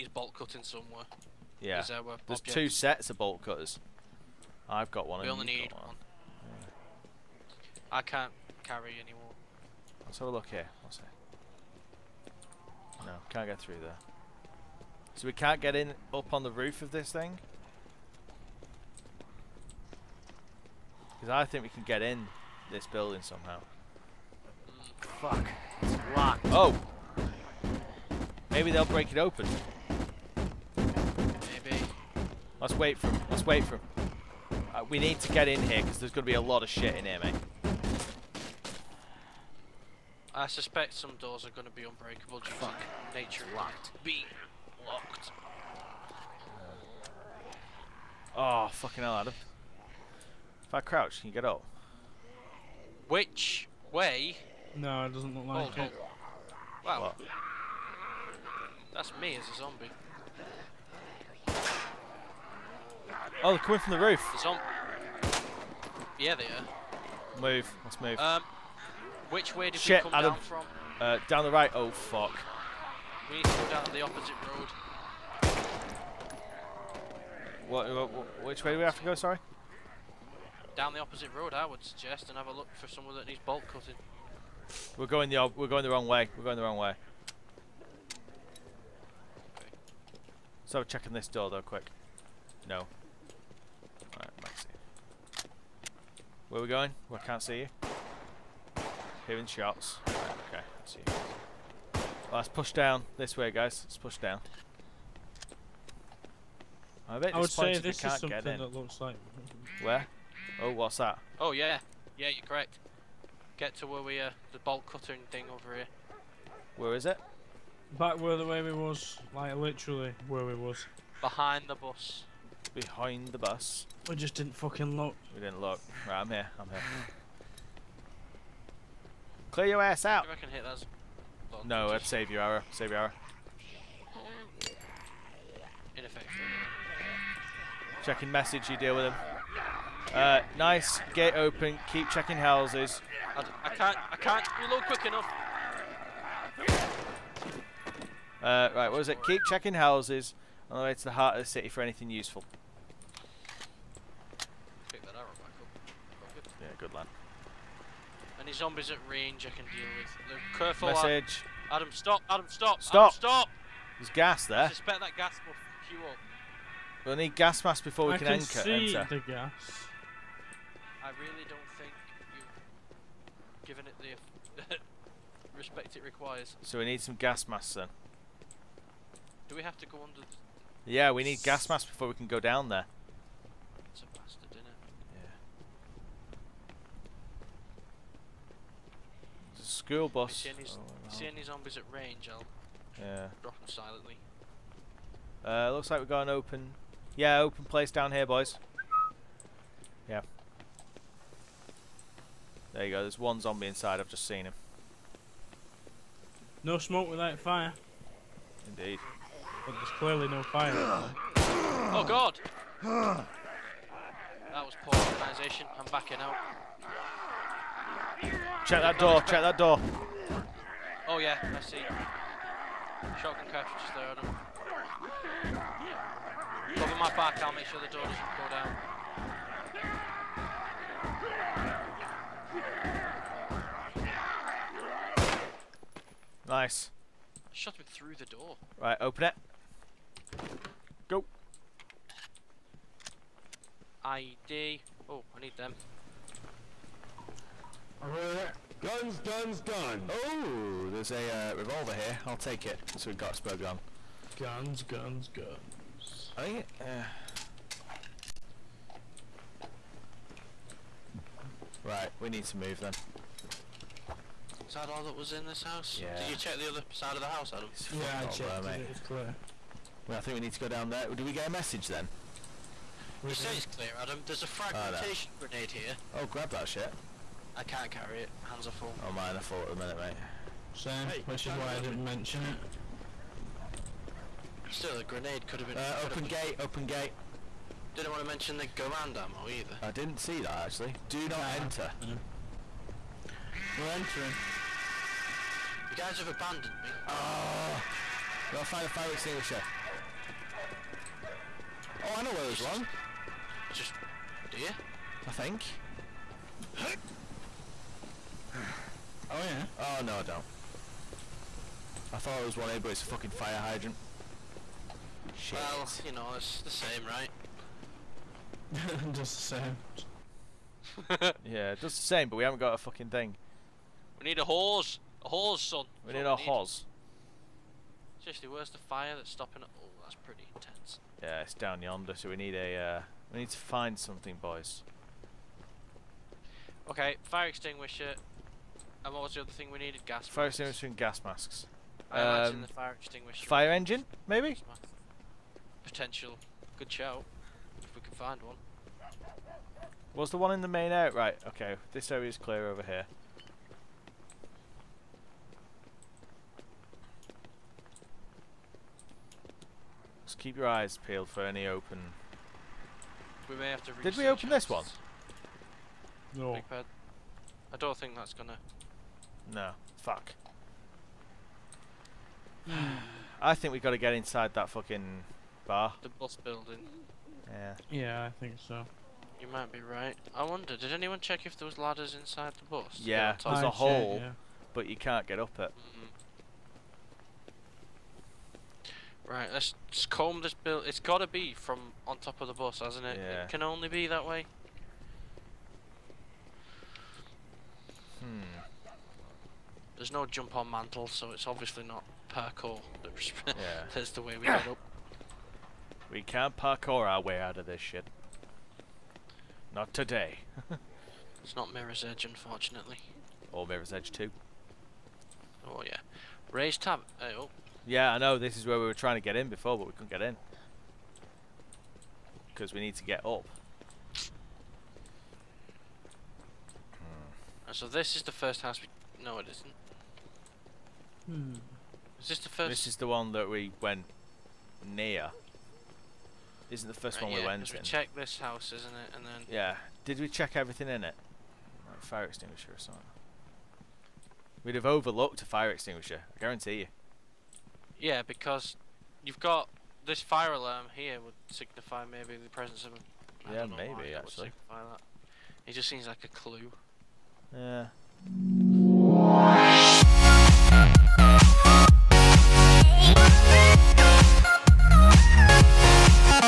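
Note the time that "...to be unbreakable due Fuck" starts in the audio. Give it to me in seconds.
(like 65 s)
41 s.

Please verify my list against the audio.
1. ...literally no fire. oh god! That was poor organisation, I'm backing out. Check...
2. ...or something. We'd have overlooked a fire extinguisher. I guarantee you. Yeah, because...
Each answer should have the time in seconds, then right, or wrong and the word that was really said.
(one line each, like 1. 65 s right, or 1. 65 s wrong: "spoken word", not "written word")
1. 209 s wrong: "clearly", not "literally"
2. 442 s right.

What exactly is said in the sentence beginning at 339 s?
And what was the other thing we needed?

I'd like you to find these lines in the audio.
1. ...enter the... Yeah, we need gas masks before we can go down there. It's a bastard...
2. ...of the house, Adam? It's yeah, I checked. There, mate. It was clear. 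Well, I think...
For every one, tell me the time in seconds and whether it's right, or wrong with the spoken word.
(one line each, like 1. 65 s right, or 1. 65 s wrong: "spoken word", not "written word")
1. 180 s wrong: "under", not "enter"
2. 267 s right.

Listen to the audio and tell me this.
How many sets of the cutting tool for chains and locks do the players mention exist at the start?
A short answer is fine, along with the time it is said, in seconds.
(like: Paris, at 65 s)
2, at 2 s.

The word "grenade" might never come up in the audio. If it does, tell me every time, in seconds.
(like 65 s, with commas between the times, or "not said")
275 s, 285 s.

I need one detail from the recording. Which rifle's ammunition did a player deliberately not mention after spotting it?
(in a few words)
Garand.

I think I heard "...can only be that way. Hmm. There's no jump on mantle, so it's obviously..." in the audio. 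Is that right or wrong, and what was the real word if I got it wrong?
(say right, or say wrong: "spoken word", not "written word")
right.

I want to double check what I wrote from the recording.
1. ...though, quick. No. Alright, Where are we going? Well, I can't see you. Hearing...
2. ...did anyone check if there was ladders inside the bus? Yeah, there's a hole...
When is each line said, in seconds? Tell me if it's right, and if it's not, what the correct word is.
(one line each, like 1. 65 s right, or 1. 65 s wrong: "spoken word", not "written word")
1. 91 s right
2. 380 s right.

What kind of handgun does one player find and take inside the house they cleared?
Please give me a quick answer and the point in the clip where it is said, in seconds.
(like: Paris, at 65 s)
Revolver, at 251 s.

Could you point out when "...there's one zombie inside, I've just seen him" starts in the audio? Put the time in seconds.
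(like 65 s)
203 s.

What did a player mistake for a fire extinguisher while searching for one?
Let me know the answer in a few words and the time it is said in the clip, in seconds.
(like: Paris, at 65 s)
Fire hydrant, at 313 s.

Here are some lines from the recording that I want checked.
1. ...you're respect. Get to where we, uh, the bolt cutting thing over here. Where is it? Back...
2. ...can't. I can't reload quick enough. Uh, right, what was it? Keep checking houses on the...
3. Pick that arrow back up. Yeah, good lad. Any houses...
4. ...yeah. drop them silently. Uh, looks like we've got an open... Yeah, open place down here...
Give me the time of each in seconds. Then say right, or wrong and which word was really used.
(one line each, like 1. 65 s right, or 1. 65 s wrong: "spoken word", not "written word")
1. 112 s wrong: "correct", not "respect"
2. 143 s right
3. 154 s wrong: "zombies", not "houses"
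4. 192 s right.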